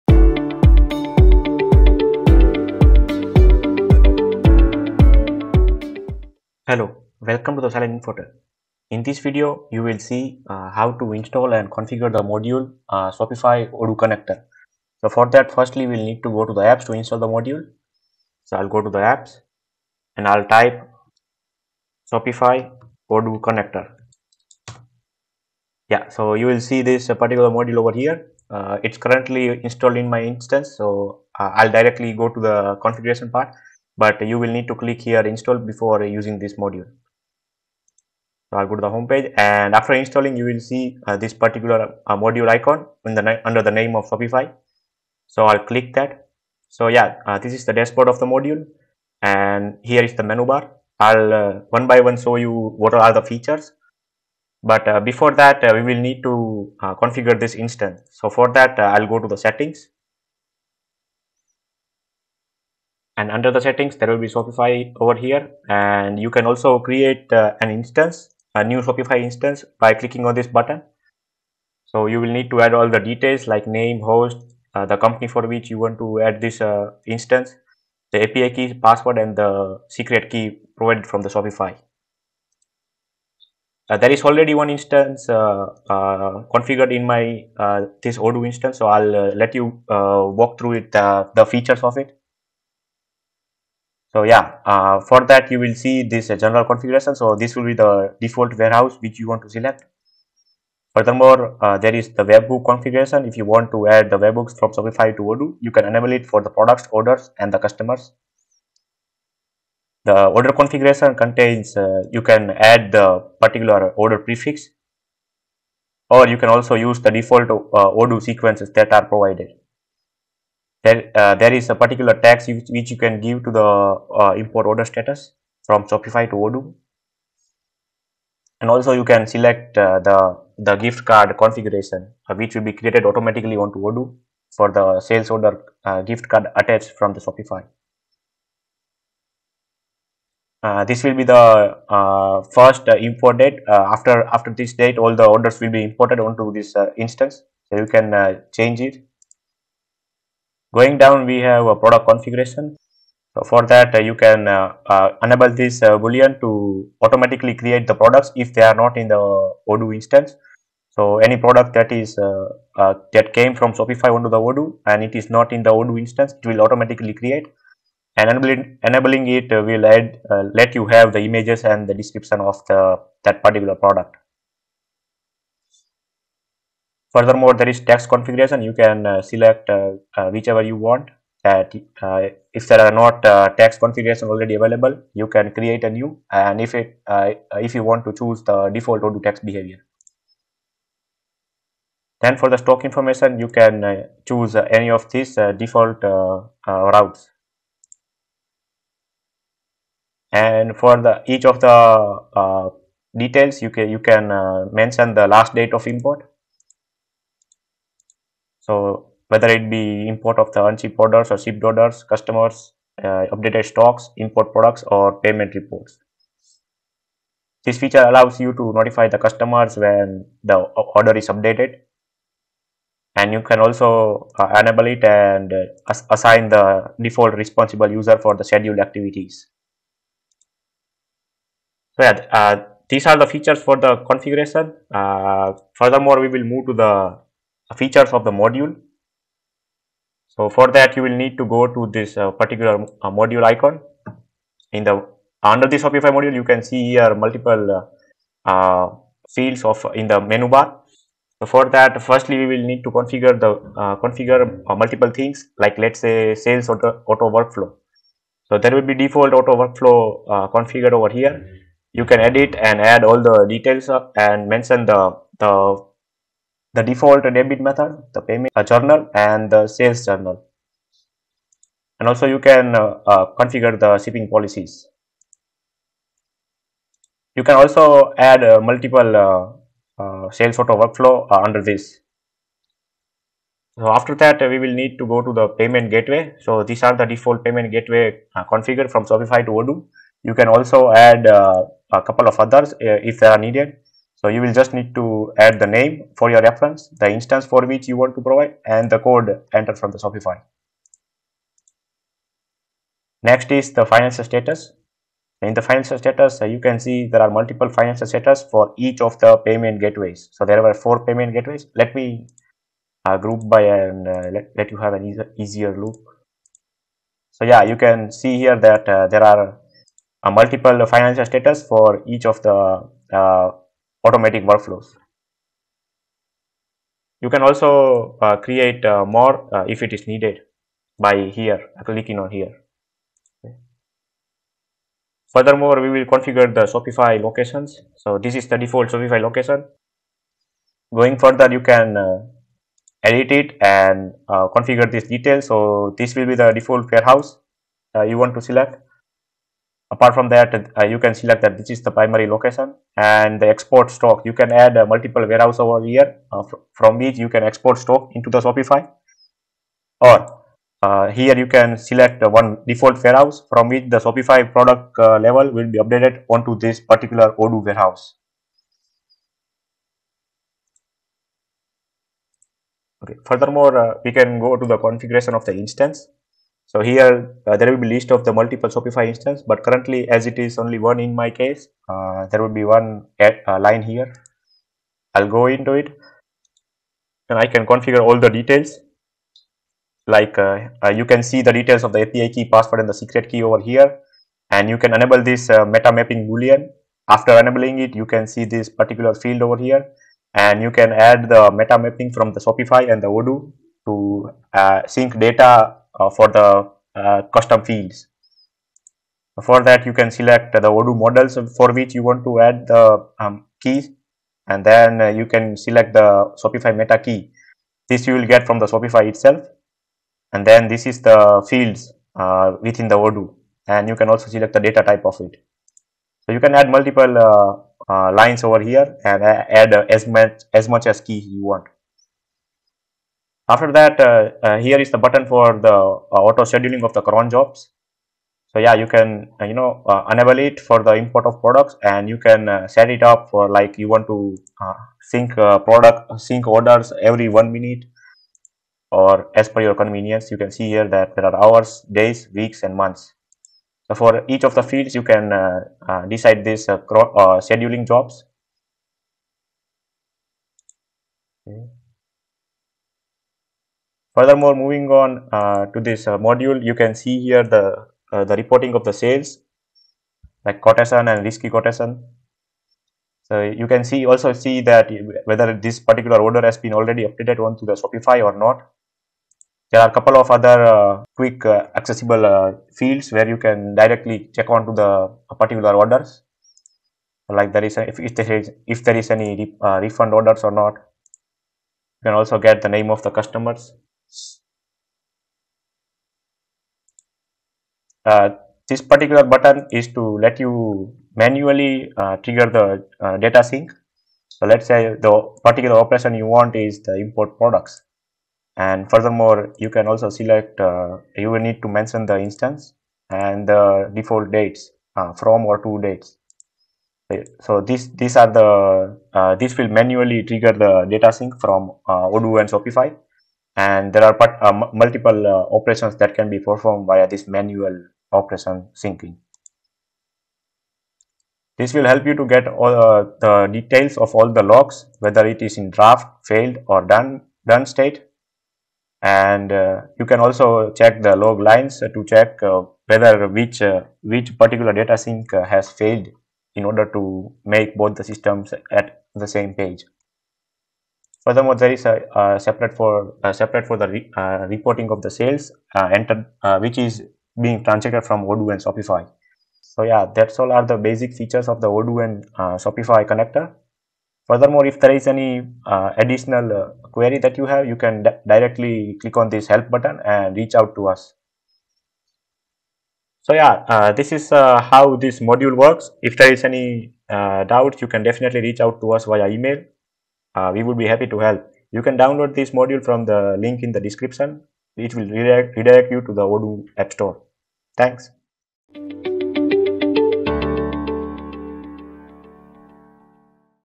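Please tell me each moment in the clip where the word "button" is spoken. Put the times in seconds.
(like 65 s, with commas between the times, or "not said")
70 s, 434 s, 499 s, 569 s.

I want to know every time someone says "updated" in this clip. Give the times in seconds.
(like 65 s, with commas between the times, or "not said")
213 s, 221 s, 365 s, 477 s.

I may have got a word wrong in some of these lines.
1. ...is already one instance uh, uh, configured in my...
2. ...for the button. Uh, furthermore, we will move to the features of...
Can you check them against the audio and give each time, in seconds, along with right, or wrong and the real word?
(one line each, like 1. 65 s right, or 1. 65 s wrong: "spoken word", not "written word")
1. 84 s right
2. 233 s wrong: "configuration", not "button".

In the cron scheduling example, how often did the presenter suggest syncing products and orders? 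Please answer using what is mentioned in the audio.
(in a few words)
Every 1 minute.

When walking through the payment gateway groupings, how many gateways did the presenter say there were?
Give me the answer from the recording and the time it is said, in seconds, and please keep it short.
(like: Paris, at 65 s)
4, at 310 s.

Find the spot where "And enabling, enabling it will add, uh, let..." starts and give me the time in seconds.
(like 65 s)
168 s.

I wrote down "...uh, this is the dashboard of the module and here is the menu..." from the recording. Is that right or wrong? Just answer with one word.
right.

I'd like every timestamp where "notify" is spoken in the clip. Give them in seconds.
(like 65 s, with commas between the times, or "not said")
218 s.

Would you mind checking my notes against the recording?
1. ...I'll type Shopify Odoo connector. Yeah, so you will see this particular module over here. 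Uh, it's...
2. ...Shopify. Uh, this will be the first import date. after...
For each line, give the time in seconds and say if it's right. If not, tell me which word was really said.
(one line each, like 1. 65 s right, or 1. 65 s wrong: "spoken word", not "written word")
1. 20 s right
2. 137 s right.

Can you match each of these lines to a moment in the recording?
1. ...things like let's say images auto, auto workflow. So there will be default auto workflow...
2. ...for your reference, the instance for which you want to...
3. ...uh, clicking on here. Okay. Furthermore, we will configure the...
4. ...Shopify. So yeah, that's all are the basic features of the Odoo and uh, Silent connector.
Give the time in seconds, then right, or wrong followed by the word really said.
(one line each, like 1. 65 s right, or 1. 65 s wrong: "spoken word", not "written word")
1. 255 s wrong: "sales", not "images"
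2. 296 s right
3. 331 s right
4. 558 s wrong: "Shopify", not "Silent".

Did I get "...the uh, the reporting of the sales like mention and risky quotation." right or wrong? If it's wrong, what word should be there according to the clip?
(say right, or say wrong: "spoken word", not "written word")
wrong: "quotation", not "mention".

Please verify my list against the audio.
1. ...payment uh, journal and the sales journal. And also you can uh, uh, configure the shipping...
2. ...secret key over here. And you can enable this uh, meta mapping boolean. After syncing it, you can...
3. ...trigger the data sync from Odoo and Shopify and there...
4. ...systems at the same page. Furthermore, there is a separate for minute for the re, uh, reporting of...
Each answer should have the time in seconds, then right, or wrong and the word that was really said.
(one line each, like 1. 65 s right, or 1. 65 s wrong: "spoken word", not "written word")
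1. 268 s right
2. 392 s wrong: "enabling", not "syncing"
3. 520 s right
4. 548 s wrong: "separate", not "minute".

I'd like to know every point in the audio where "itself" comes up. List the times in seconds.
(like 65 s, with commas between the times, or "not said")
419 s.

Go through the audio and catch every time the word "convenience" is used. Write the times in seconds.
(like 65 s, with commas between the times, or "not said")
449 s.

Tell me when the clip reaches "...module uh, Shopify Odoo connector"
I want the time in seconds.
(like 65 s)
12 s.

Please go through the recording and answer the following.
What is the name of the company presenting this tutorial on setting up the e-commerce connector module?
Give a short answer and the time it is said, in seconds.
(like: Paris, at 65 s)
Silent Infotech, at 7 s.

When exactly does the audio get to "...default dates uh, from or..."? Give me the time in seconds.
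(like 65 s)
513 s.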